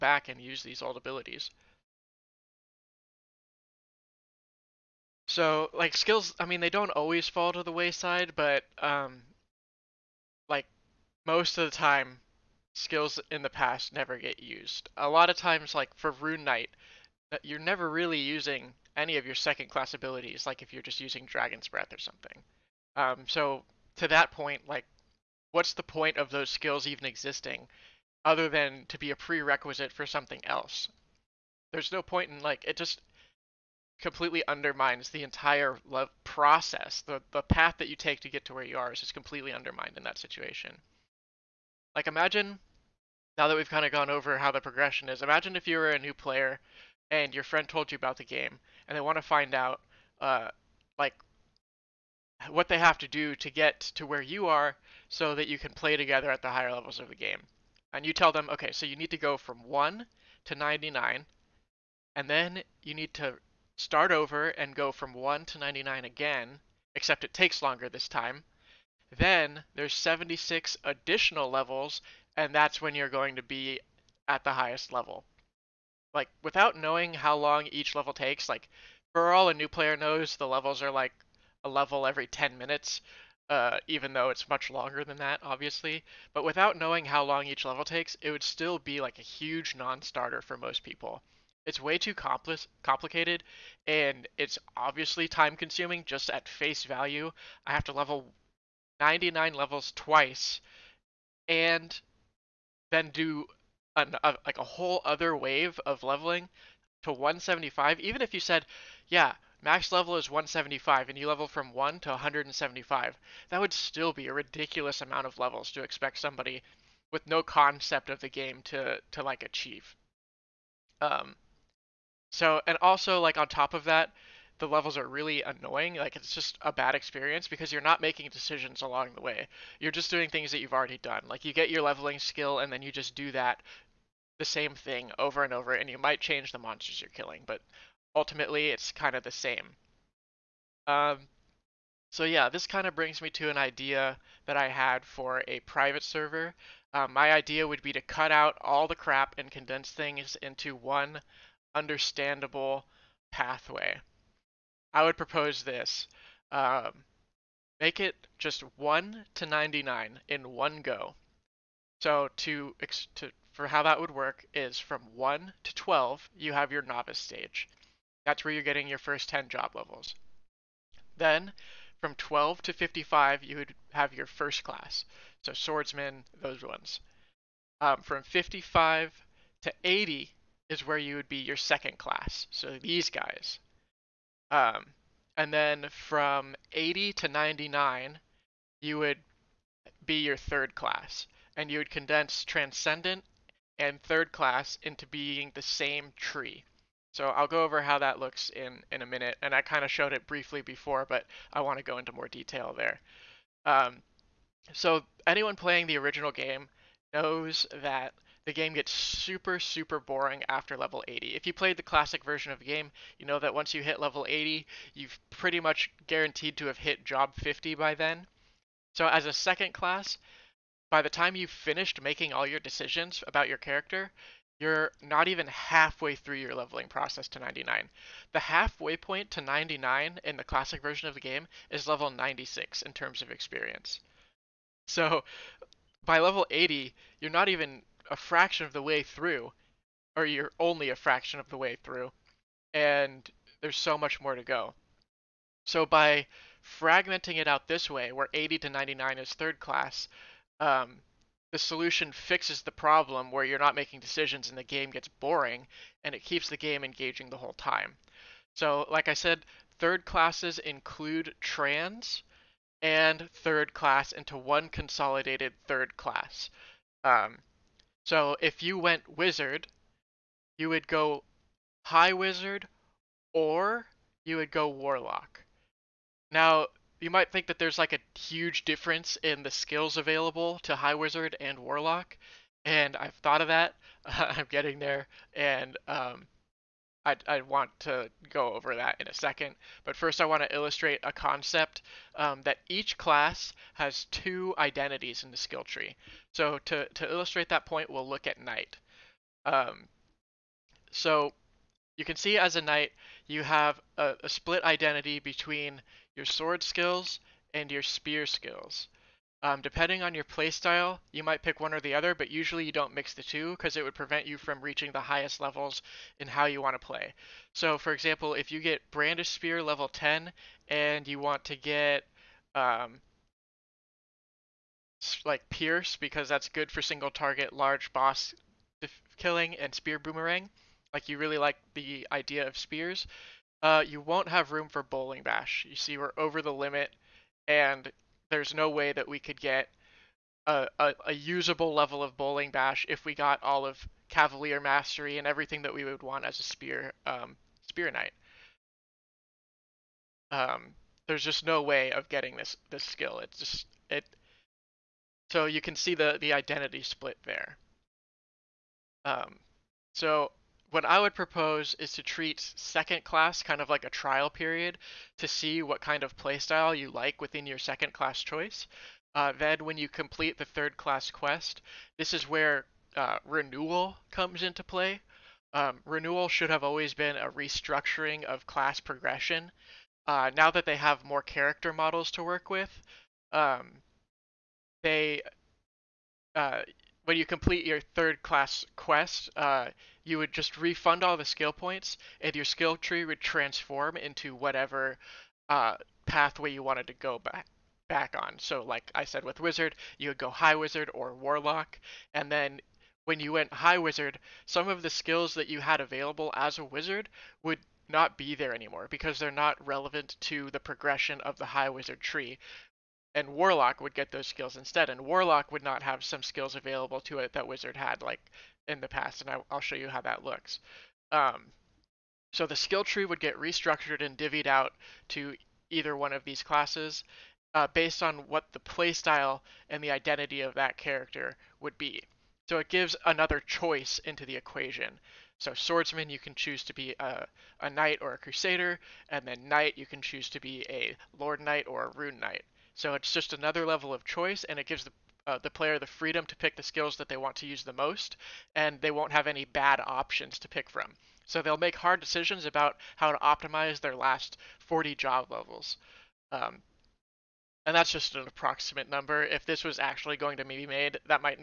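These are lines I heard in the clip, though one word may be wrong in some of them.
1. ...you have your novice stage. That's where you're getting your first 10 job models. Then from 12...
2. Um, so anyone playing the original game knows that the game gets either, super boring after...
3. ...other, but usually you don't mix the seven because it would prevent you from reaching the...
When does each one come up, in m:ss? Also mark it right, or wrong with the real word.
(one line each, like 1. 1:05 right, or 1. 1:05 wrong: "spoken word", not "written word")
1. 2:46 wrong: "levels", not "models"
2. 3:23 wrong: "super", not "either"
3. 5:11 wrong: "two", not "seven".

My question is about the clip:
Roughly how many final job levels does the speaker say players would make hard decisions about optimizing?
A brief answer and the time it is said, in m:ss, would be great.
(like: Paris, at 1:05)
40, at 7:34.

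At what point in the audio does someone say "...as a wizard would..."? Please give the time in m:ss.
6:46.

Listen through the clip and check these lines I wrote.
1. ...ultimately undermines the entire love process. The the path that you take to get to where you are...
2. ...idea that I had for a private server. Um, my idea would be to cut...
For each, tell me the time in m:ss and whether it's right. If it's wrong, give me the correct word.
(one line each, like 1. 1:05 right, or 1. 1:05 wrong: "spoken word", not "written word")
1. 0:34 wrong: "completely", not "ultimately"
2. 2:23 right.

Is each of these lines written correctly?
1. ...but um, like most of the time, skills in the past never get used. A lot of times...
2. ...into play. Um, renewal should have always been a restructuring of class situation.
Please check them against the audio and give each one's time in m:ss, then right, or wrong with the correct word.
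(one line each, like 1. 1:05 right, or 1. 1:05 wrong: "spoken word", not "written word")
1. 0:08 right
2. 6:14 wrong: "progression", not "situation".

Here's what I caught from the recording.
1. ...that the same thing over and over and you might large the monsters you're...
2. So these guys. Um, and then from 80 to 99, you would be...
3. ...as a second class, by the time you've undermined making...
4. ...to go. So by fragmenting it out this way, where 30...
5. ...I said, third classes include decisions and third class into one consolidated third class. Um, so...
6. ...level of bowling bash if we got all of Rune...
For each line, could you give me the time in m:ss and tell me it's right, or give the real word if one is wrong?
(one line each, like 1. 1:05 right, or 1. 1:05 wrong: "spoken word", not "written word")
1. 2:13 wrong: "change", not "large"
2. 3:02 right
3. 3:39 wrong: "finished", not "undermined"
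4. 4:04 wrong: "80", not "30"
5. 4:19 wrong: "trans", not "decisions"
6. 5:41 wrong: "Cavalier", not "Rune".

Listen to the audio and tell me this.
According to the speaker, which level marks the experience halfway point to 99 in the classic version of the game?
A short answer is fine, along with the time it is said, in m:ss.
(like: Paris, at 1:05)
96, at 3:51.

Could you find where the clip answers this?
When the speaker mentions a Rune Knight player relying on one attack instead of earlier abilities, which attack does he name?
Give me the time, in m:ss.
0:21.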